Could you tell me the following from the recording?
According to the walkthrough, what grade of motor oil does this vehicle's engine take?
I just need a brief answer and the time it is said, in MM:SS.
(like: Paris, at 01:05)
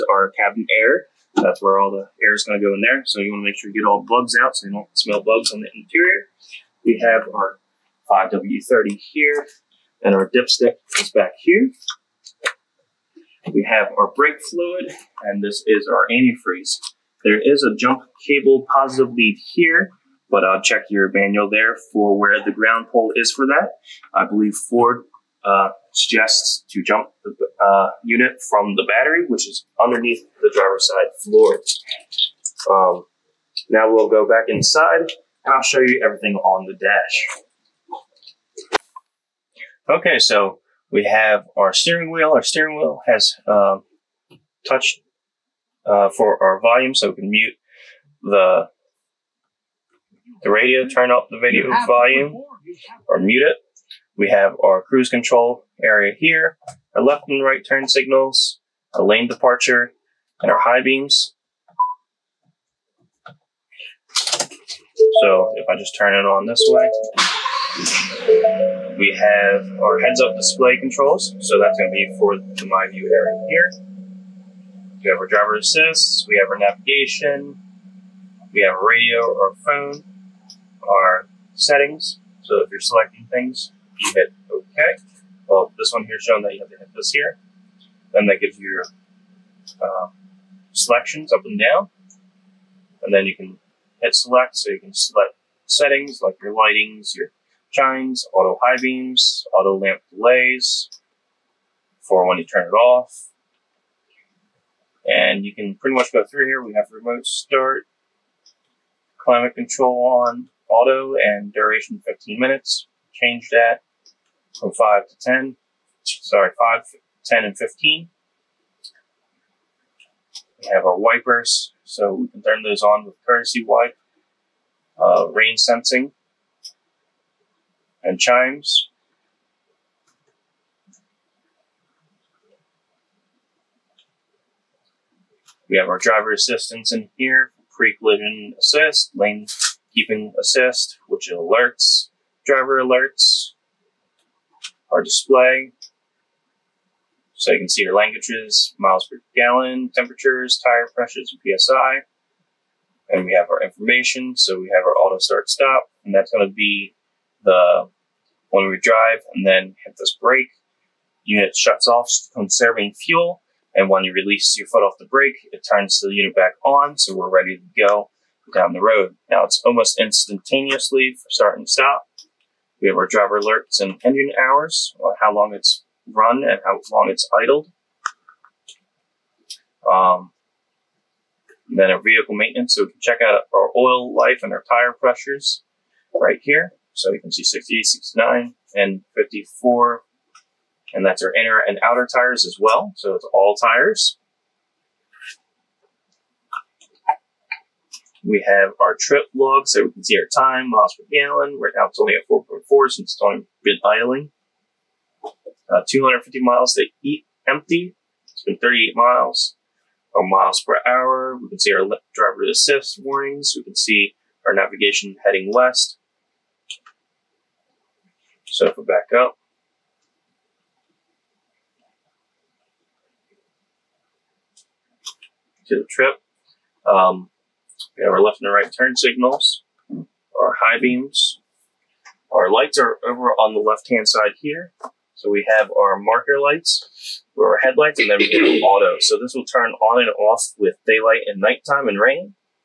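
5W30, at 00:08.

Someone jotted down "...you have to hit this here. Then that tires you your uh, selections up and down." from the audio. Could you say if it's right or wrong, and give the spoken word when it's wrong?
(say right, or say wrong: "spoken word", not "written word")
wrong: "gives", not "tires".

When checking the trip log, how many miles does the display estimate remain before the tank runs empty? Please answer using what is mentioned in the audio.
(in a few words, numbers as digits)
250.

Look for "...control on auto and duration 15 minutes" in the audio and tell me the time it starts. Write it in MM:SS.
01:49.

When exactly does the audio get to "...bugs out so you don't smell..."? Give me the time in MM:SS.
00:04.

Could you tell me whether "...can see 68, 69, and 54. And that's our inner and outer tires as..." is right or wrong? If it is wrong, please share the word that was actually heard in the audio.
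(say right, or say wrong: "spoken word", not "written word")
right.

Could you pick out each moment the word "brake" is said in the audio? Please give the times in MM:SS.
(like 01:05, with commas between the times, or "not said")
00:14, 02:40, 02:45.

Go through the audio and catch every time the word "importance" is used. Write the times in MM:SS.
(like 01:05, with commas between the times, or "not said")
not said.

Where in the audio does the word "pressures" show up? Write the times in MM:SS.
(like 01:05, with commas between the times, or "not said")
02:30, 03:04.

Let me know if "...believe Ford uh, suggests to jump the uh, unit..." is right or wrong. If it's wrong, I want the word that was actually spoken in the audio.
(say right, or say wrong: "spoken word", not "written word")
right.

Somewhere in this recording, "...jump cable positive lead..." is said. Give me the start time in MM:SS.
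00:17.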